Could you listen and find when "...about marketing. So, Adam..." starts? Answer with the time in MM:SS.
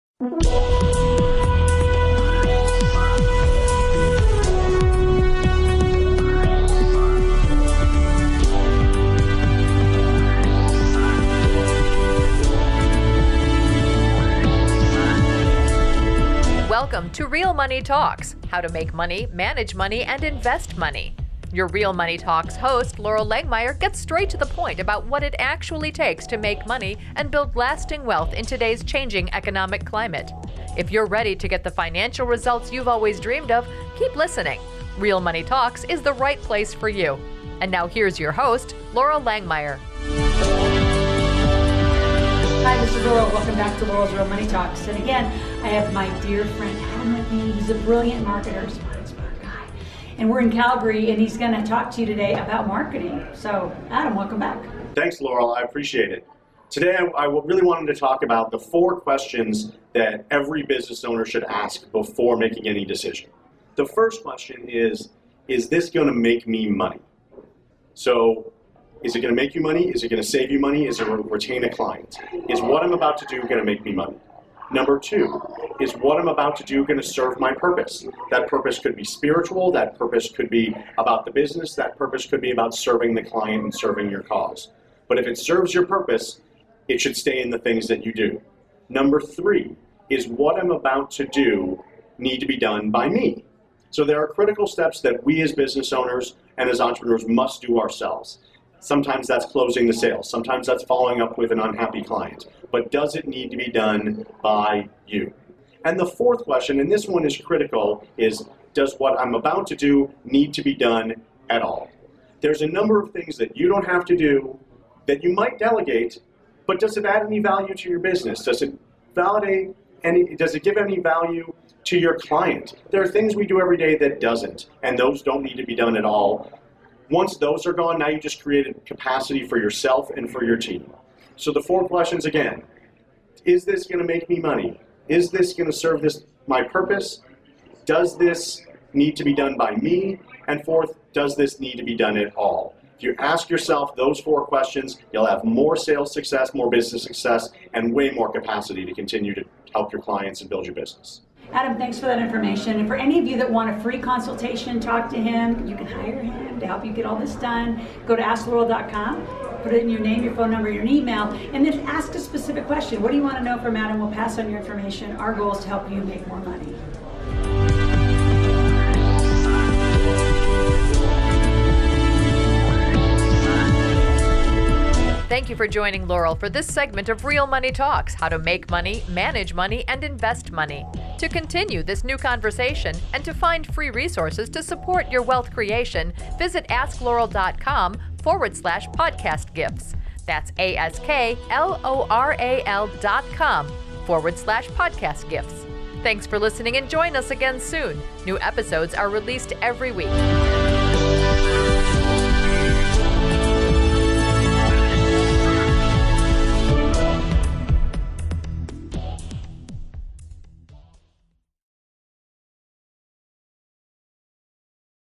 00:52.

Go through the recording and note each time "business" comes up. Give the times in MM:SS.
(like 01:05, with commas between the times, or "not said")
01:00, 01:21, 01:35, 01:57, 02:26, 02:30.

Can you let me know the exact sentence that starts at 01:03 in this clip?
The first question is Is this going to make me money?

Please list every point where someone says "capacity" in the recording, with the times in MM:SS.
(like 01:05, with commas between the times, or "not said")
02:08, 02:28.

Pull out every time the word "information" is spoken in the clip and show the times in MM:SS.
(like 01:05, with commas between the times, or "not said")
02:32, 02:44.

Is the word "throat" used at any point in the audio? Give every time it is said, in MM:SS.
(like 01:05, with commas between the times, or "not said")
not said.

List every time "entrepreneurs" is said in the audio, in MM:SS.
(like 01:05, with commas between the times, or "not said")
01:36.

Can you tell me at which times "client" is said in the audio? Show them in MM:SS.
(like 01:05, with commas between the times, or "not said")
01:11, 01:23, 01:42, 02:02, 02:30.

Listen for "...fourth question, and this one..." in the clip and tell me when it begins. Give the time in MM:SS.
01:46.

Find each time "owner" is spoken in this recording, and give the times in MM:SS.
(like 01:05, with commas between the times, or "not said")
01:01, 01:35.